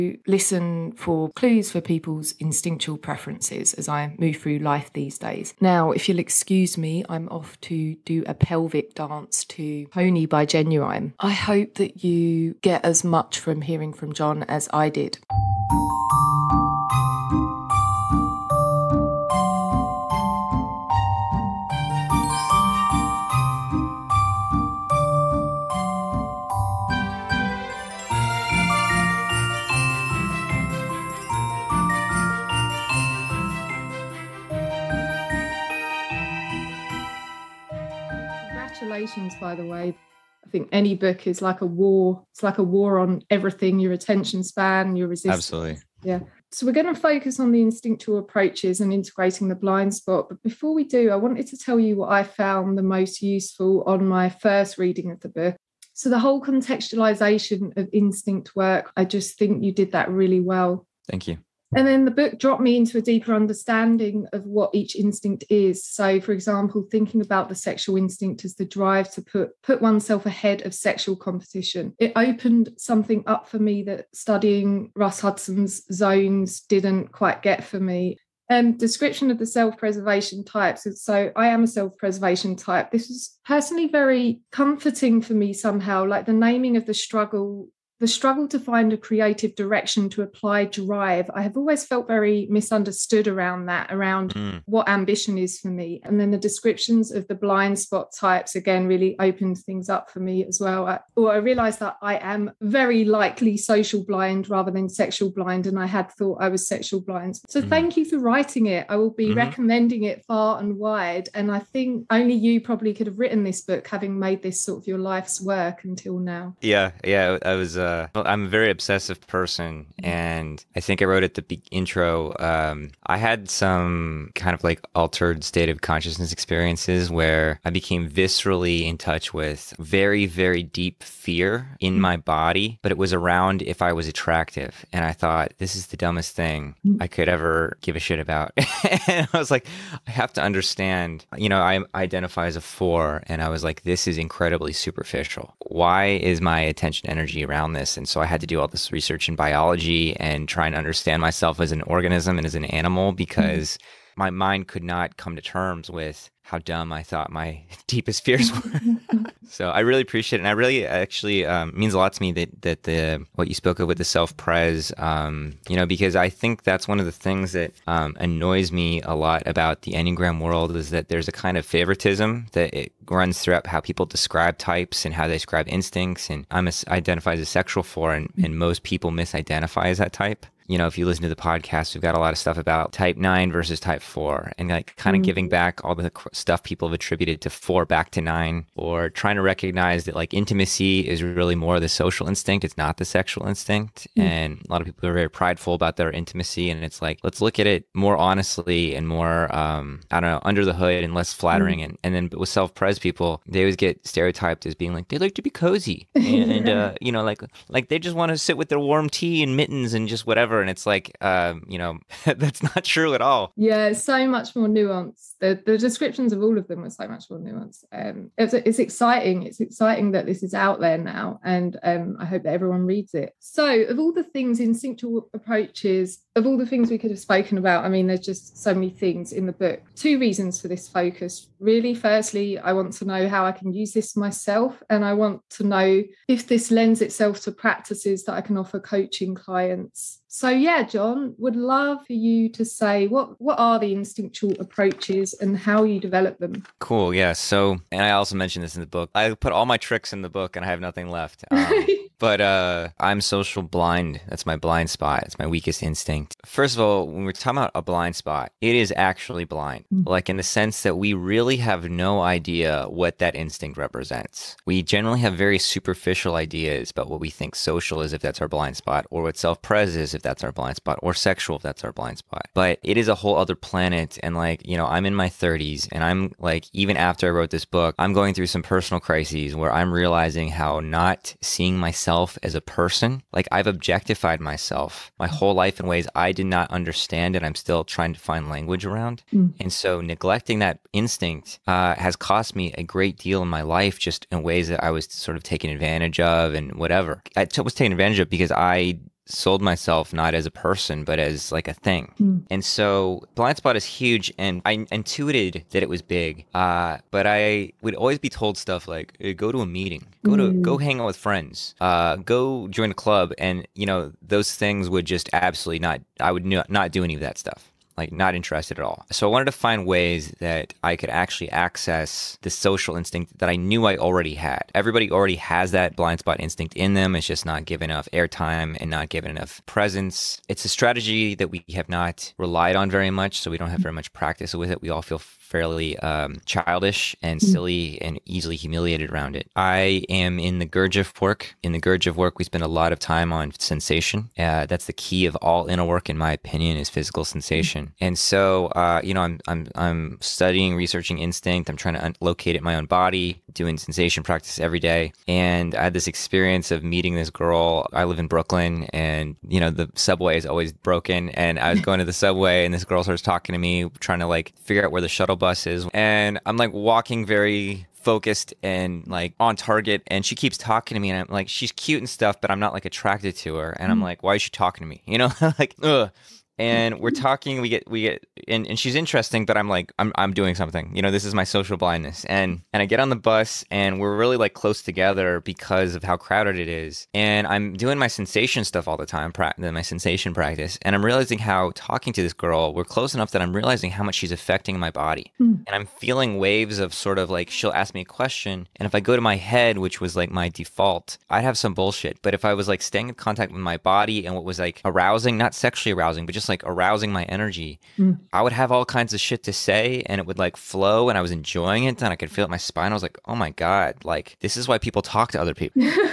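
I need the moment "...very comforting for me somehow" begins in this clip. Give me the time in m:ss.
1:23.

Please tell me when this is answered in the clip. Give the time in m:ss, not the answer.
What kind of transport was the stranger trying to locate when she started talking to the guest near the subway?
6:05.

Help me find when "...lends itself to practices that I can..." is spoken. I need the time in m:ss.
3:56.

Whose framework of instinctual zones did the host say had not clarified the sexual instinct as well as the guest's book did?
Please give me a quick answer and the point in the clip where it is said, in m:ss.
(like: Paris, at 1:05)
Russ Hudson, at 1:14.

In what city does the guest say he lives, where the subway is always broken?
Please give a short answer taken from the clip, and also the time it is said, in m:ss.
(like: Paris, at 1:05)
Brooklyn, at 5:58.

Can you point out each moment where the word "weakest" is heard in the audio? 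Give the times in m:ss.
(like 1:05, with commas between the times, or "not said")
4:15.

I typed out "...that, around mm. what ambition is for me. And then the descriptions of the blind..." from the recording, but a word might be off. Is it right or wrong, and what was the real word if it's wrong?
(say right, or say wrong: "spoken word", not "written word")
right.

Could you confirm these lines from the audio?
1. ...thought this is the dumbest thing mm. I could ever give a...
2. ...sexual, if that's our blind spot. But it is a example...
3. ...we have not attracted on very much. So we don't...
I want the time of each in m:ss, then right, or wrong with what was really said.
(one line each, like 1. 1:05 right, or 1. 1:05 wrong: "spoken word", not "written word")
1. 2:15 right
2. 4:31 wrong: "whole", not "example"
3. 5:31 wrong: "relied", not "attracted".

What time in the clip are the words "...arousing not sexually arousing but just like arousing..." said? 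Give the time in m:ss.
6:44.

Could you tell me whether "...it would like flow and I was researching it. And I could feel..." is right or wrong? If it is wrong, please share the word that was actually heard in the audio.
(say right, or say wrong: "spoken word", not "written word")
wrong: "enjoying", not "researching".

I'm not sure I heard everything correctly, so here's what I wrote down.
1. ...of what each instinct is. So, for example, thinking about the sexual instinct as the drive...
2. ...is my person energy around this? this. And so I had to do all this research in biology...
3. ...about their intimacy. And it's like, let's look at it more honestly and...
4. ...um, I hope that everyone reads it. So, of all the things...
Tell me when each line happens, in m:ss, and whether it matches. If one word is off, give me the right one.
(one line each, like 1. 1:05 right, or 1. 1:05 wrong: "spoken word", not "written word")
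1. 1:04 right
2. 2:26 wrong: "attention", not "person"
3. 3:15 right
4. 3:41 right.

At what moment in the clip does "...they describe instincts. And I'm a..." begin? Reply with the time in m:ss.
2:55.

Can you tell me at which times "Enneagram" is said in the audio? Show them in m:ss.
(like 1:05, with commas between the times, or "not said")
2:49.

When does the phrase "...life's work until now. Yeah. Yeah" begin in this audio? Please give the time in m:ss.
1:54.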